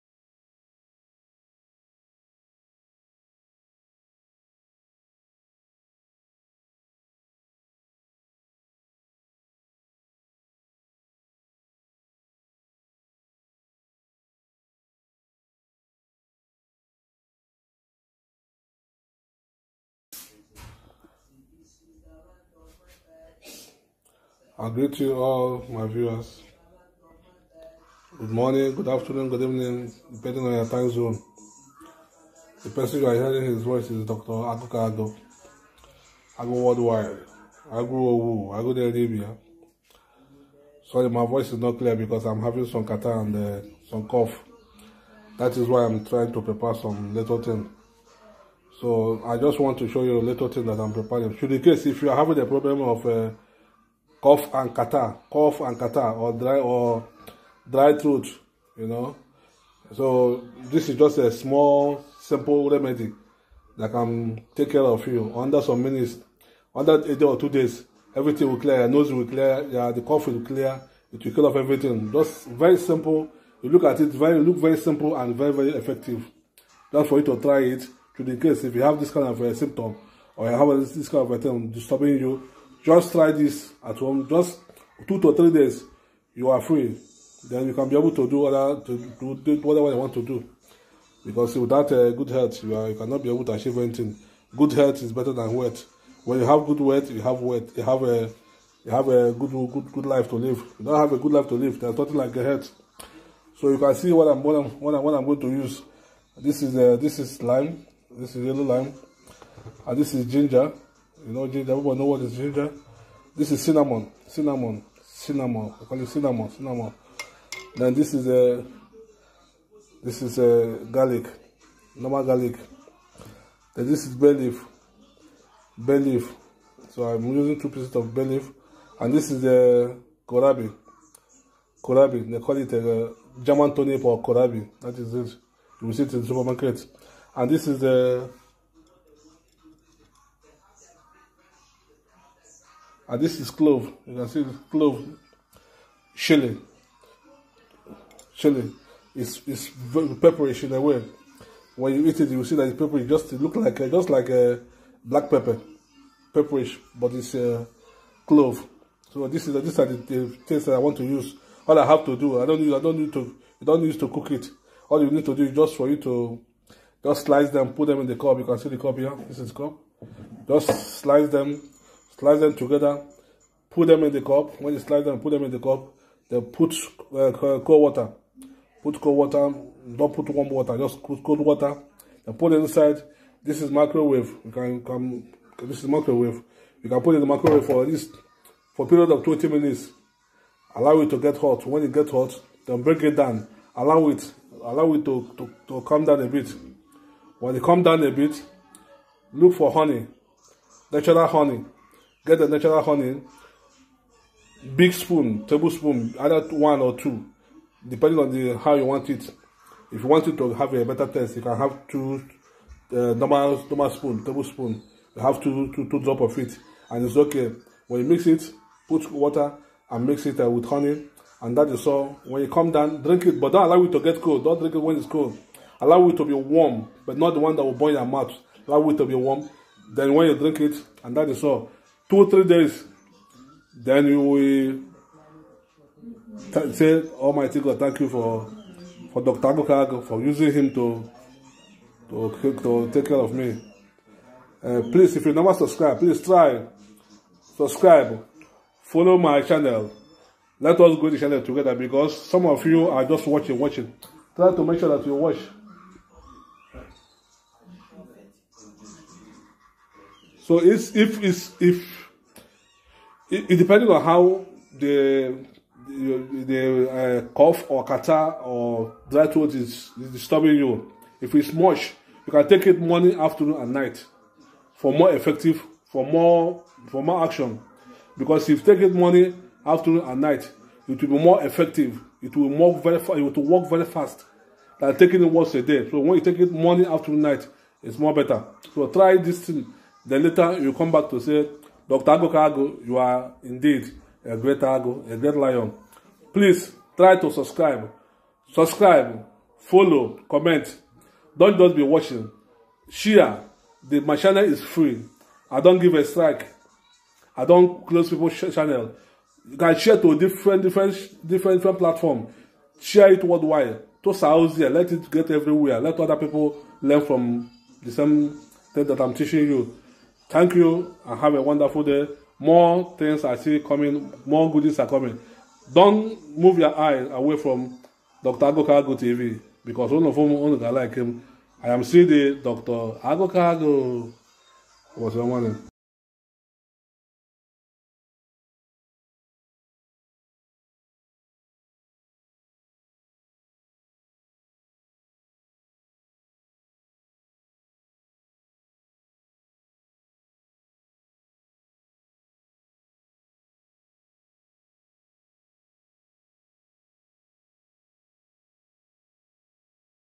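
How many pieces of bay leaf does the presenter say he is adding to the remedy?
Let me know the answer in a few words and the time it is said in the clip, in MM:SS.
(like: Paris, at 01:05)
2, at 02:07.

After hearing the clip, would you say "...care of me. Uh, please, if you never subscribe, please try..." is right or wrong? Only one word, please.
right.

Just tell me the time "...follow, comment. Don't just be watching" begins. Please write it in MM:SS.
04:59.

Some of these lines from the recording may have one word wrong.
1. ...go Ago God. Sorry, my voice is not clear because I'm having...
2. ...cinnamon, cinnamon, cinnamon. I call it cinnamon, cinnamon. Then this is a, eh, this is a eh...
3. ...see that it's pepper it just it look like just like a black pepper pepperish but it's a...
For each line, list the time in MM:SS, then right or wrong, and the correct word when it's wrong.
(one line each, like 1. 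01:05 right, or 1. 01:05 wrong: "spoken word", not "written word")
1. 00:37 wrong: "Arabia", not "God"
2. 01:53 right
3. 02:32 right.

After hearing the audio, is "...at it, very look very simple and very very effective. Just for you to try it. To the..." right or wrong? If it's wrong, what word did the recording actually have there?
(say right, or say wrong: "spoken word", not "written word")
right.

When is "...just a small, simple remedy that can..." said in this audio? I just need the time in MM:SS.
01:00.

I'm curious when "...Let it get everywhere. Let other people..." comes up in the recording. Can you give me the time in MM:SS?
05:14.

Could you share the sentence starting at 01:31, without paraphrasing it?
Because without uh, good health, you, are, you cannot be able to achieve anything.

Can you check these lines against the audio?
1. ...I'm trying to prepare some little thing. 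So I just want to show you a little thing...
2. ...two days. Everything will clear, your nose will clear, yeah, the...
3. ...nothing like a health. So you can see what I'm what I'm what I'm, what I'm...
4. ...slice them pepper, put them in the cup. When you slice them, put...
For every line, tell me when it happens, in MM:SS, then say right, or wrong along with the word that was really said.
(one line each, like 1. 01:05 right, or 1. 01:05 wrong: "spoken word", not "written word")
1. 00:45 right
2. 01:07 right
3. 01:41 right
4. 02:52 wrong: "together", not "pepper".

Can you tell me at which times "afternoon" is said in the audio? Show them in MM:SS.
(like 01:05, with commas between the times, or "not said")
00:28, 04:33, 04:39, 04:46.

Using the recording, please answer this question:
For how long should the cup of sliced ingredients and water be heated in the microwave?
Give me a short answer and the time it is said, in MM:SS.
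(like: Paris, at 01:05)
20 minutes, at 03:09.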